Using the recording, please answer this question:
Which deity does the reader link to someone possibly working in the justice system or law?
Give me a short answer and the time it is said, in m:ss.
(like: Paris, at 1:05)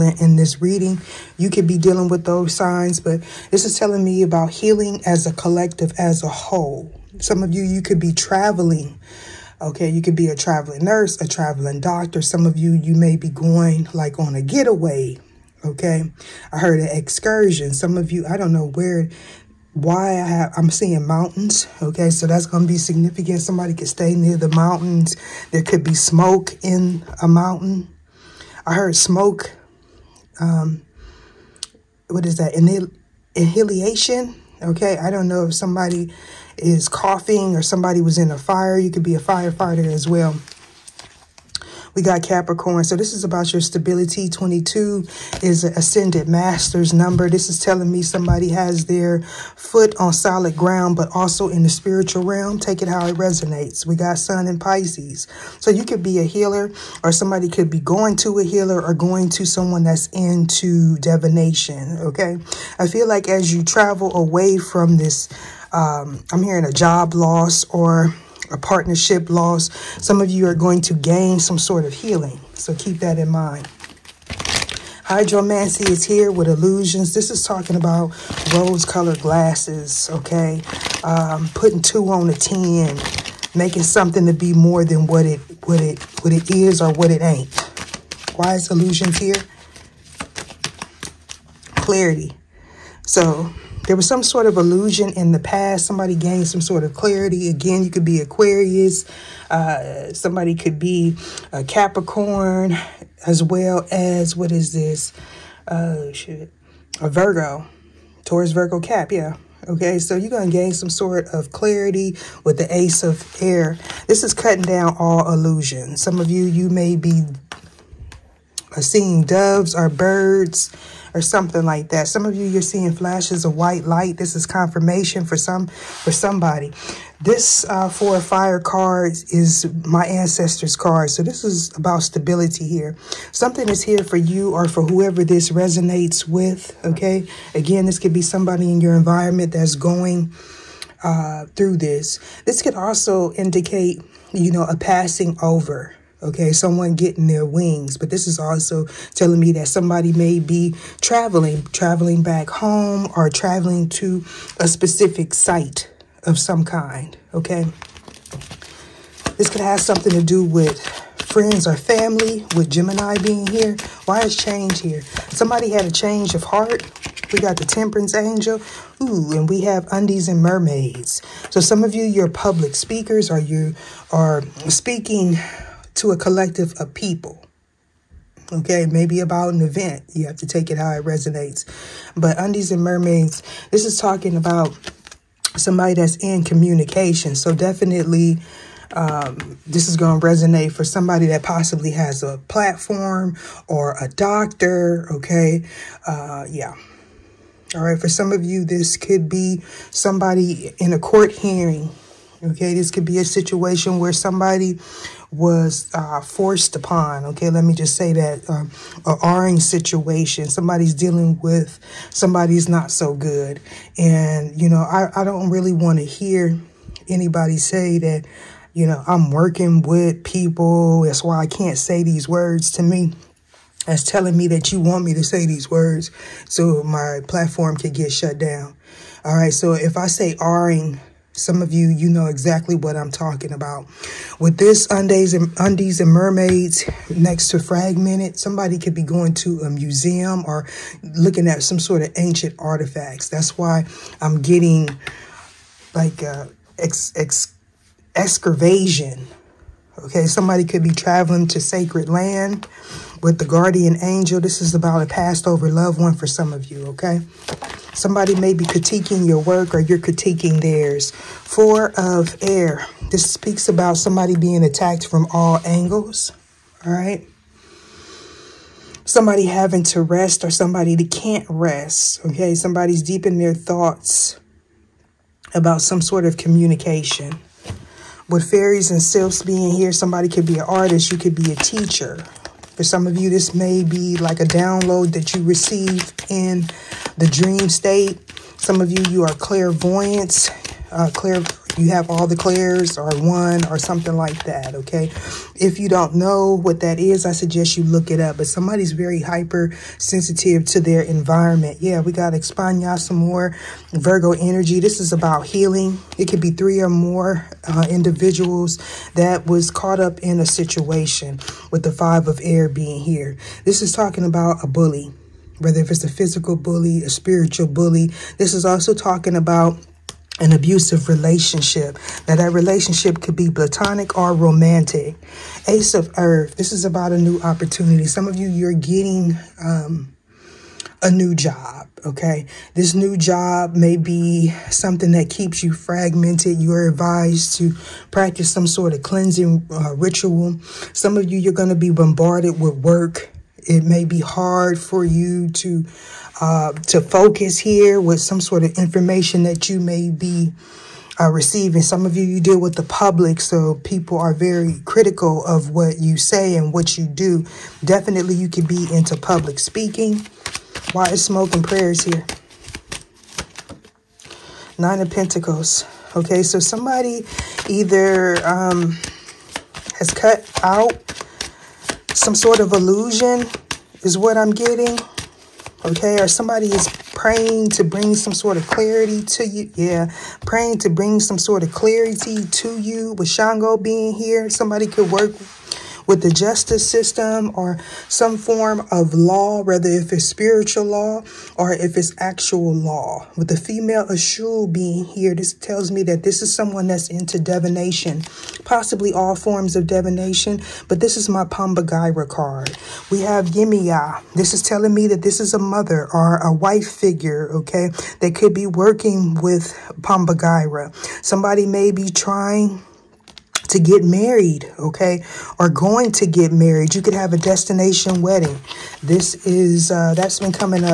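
Shango, at 6:23.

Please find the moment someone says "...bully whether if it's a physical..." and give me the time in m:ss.
5:14.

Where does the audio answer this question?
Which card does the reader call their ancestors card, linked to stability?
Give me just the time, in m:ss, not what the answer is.
2:07.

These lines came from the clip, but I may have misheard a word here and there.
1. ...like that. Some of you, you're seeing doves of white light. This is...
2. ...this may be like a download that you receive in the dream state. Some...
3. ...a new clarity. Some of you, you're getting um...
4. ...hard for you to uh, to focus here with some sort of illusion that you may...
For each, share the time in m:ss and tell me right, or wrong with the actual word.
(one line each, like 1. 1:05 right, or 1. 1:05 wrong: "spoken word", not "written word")
1. 2:01 wrong: "flashes", not "doves"
2. 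4:43 right
3. 5:27 wrong: "opportunity", not "clarity"
4. 5:44 wrong: "information", not "illusion".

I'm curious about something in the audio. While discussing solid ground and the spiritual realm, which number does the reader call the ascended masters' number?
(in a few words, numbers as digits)
22.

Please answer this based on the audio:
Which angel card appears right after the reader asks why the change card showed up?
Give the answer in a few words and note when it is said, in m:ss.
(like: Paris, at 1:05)
Temperance, at 2:47.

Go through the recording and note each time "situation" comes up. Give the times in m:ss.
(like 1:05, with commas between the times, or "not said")
3:23, 3:29, 5:10.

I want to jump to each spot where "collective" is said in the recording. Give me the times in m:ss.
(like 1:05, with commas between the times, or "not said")
0:05, 2:56.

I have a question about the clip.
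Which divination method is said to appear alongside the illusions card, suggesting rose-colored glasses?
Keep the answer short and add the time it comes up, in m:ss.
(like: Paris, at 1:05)
Hydromancy, at 1:15.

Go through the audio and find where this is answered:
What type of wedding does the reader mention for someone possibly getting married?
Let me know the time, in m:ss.
6:57.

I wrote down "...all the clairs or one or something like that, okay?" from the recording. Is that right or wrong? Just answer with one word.
right.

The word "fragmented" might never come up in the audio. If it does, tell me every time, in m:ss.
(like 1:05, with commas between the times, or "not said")
3:57, 5:35.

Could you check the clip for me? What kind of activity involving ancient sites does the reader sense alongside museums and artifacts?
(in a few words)
Excavation.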